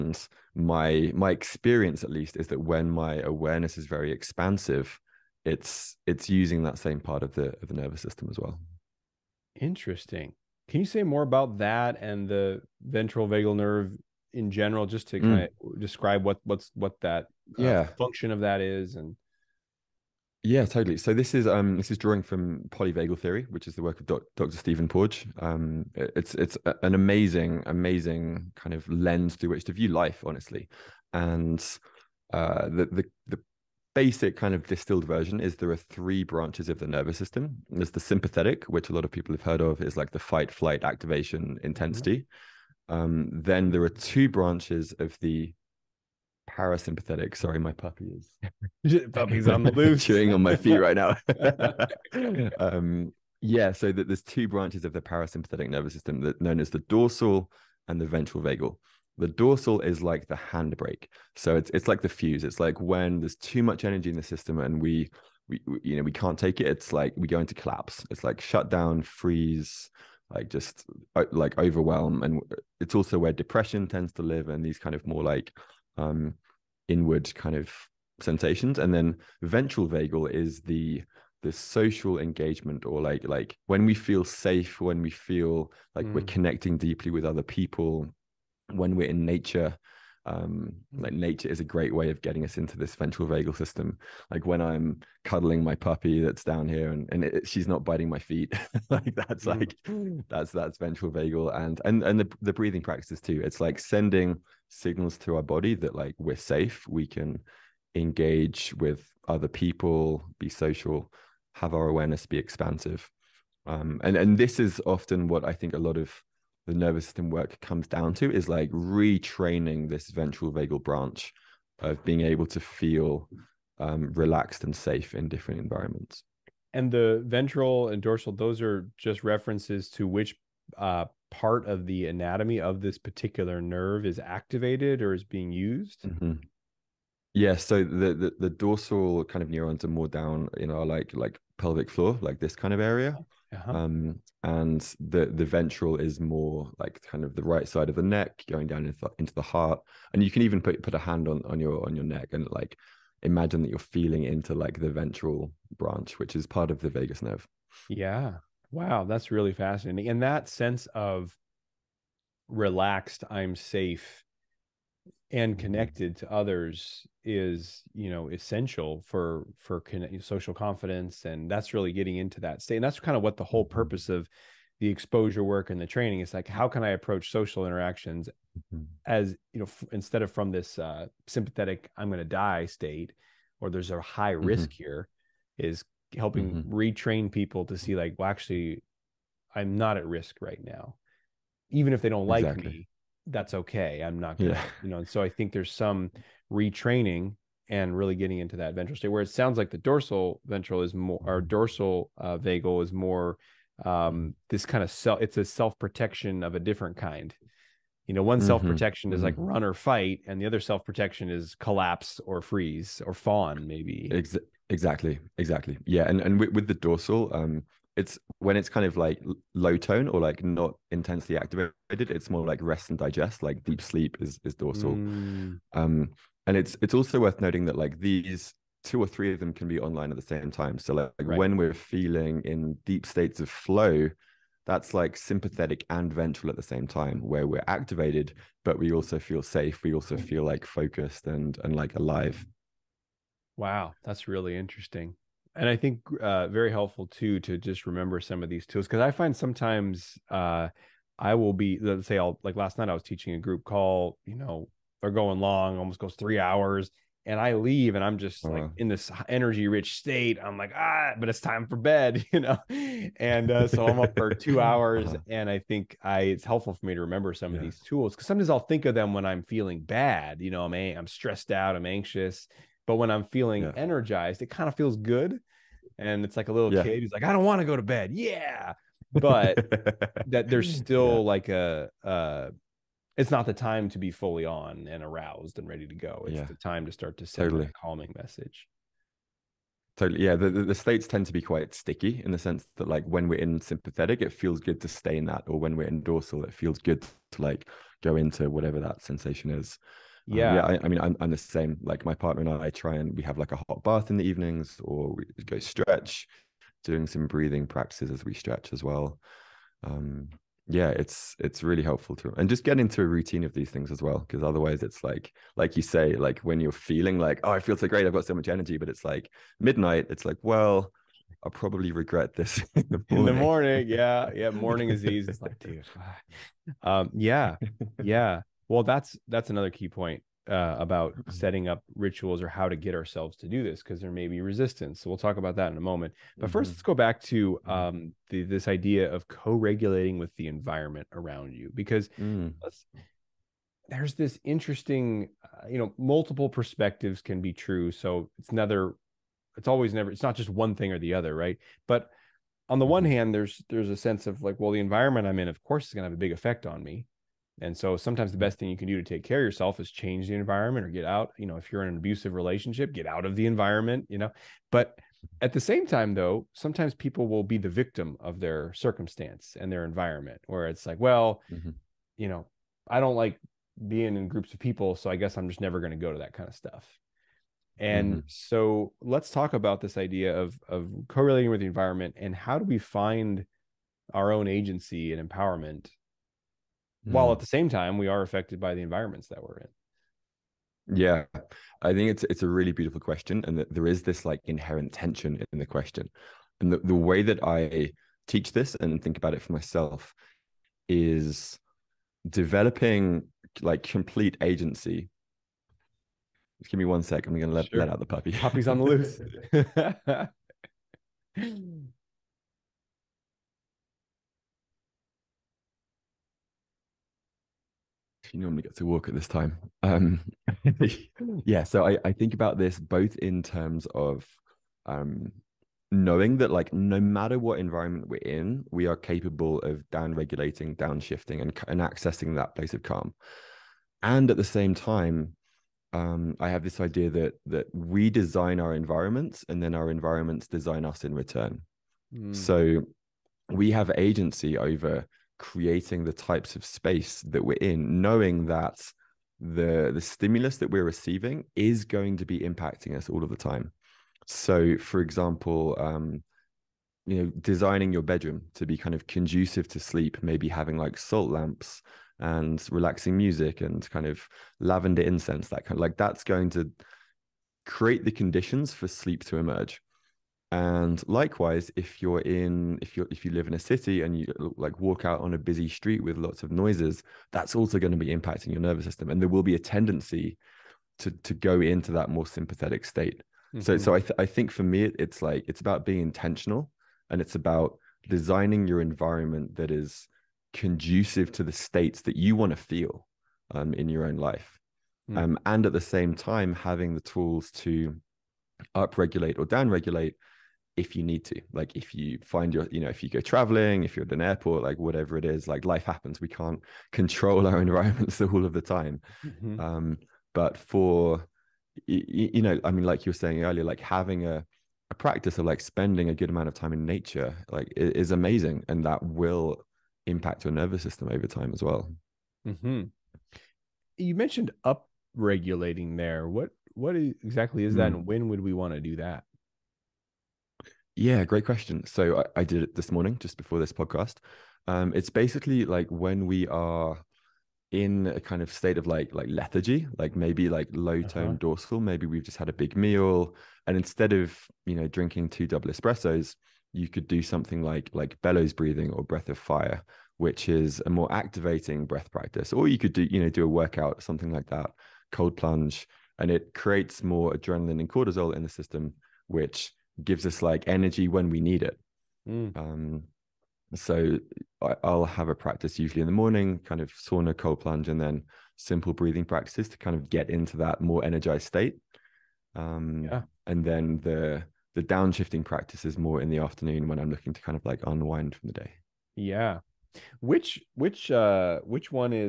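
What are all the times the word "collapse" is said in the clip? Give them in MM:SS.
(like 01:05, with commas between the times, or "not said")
01:07, 03:31.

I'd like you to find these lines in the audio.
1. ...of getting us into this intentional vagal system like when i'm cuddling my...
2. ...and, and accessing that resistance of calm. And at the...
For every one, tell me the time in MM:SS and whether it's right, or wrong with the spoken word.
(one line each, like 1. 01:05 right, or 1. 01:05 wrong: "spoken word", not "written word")
1. 01:32 wrong: "ventral", not "intentional"
2. 07:11 wrong: "place", not "resistance".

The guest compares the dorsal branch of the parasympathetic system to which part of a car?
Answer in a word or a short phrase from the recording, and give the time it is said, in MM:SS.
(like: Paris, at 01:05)
the handbrake, at 01:00.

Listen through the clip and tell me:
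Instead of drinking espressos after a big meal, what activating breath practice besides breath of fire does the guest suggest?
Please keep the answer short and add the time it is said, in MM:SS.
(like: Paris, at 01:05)
bellows breathing, at 09:08.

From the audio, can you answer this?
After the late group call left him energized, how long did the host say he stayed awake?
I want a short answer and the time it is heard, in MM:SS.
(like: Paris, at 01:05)
2 hours, at 04:24.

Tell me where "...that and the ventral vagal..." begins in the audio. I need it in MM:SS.
00:11.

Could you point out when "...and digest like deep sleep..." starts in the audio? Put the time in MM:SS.
03:42.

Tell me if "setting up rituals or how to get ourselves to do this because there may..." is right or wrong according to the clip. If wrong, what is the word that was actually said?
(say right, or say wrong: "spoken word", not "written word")
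right.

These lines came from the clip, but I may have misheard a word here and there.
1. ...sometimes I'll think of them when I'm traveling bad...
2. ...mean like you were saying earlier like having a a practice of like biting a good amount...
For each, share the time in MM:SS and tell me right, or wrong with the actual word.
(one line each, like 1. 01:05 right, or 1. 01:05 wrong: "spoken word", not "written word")
1. 04:28 wrong: "feeling", not "traveling"
2. 08:32 wrong: "spending", not "biting".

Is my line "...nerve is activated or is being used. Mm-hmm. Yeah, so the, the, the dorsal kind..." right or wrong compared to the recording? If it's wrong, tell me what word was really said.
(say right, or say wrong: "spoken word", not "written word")
right.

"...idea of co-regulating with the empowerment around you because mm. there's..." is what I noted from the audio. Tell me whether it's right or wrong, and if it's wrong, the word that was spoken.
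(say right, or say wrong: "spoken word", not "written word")
wrong: "environment", not "empowerment".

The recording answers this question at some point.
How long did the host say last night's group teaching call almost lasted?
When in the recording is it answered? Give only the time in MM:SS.
04:16.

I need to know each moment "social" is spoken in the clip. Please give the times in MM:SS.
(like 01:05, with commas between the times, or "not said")
01:21, 01:50, 02:50, 02:57.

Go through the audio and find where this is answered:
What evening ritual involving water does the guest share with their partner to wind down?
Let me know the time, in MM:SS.
05:03.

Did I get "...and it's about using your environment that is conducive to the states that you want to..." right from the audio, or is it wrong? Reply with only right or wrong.
wrong.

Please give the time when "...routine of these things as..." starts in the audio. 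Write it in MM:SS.
05:13.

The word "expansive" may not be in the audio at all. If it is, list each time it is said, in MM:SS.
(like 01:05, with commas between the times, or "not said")
00:04, 01:52.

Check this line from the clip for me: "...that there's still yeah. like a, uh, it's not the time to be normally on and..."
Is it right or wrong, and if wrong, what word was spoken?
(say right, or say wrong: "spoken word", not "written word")
wrong: "fully", not "normally".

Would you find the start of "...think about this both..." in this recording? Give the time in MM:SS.
07:02.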